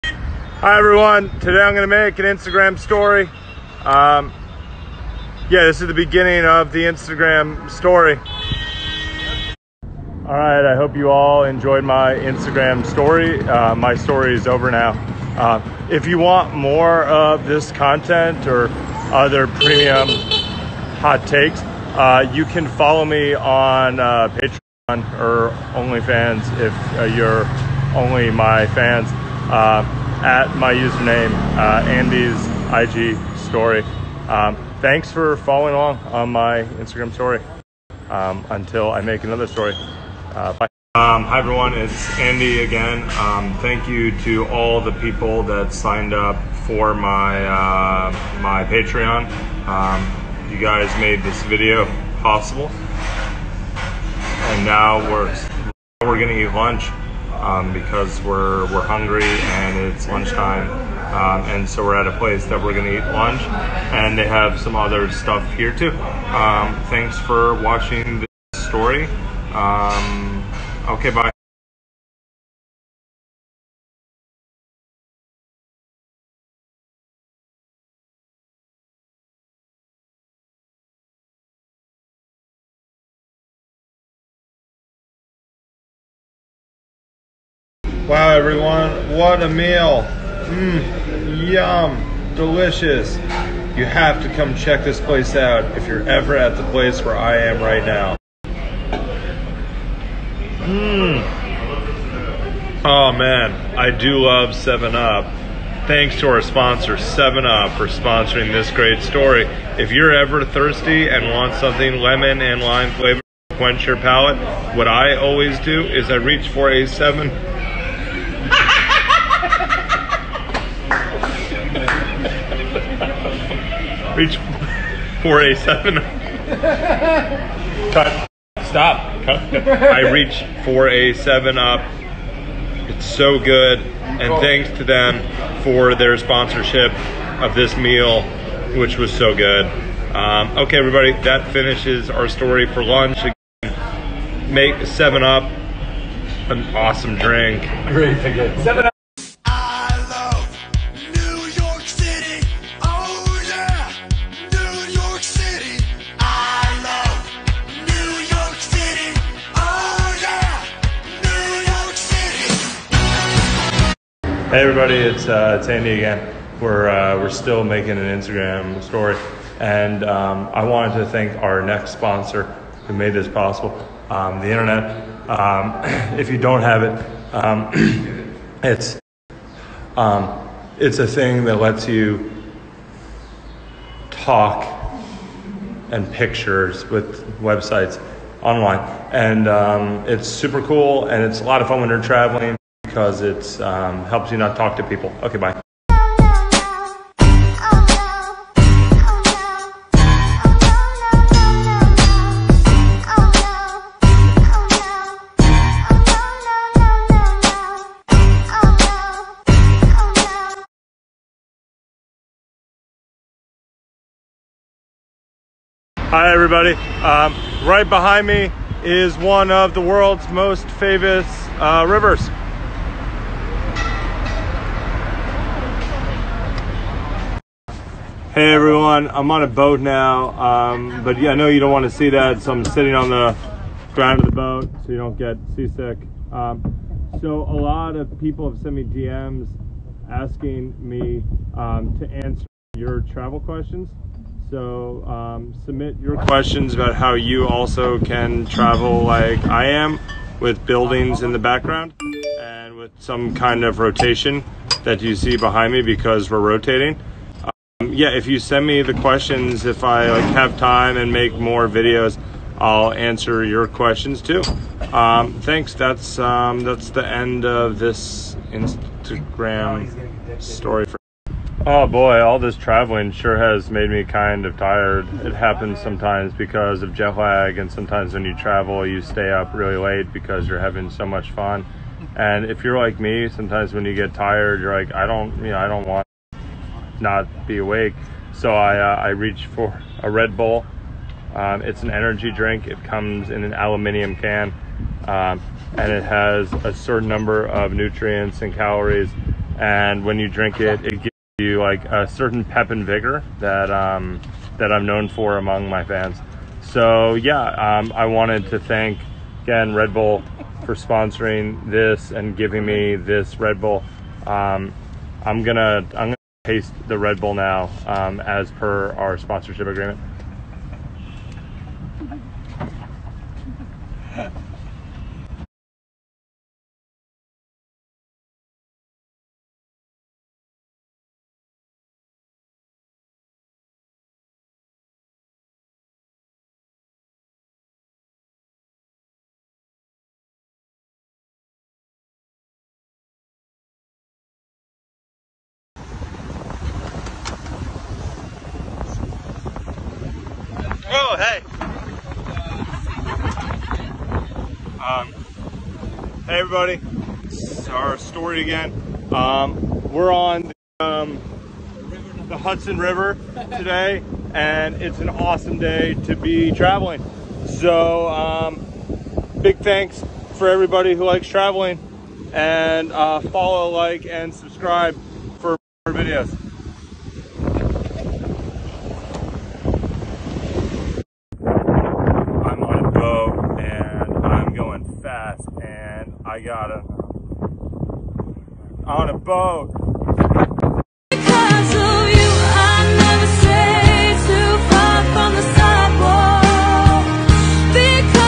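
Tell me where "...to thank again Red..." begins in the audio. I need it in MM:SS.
05:08.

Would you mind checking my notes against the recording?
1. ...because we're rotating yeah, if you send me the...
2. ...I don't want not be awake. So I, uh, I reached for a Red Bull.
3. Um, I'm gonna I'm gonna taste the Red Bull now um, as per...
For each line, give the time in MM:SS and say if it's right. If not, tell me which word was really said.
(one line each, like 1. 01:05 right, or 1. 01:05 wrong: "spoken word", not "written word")
1. 04:15 right
2. 04:45 right
3. 05:14 right.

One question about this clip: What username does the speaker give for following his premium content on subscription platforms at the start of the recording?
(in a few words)
Andy's IG story.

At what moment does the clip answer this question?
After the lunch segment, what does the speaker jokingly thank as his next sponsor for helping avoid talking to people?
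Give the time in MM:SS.
02:54.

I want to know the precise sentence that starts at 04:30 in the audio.
For- oh boy, all this traveling sure has made me kind of tired.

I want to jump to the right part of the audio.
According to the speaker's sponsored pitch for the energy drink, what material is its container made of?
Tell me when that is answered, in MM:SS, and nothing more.
04:53.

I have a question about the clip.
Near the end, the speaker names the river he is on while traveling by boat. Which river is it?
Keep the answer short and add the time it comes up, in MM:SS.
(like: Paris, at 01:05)
Hudson River, at 06:02.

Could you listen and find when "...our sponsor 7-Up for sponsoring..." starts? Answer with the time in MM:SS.
01:46.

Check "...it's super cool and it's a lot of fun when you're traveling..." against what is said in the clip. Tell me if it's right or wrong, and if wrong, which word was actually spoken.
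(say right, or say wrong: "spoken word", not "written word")
right.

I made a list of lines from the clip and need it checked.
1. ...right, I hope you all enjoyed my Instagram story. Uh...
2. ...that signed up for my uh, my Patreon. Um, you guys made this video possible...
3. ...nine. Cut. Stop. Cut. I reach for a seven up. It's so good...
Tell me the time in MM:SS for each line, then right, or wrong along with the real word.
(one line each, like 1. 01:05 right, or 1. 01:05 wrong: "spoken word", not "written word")
1. 00:10 right
2. 00:45 right
3. 02:05 wrong: "seven", not "nine".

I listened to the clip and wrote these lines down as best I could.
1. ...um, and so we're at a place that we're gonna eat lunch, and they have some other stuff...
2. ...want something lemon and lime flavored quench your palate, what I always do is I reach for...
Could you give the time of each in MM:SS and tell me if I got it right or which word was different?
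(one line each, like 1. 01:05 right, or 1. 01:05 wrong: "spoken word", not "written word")
1. 01:01 right
2. 01:51 right.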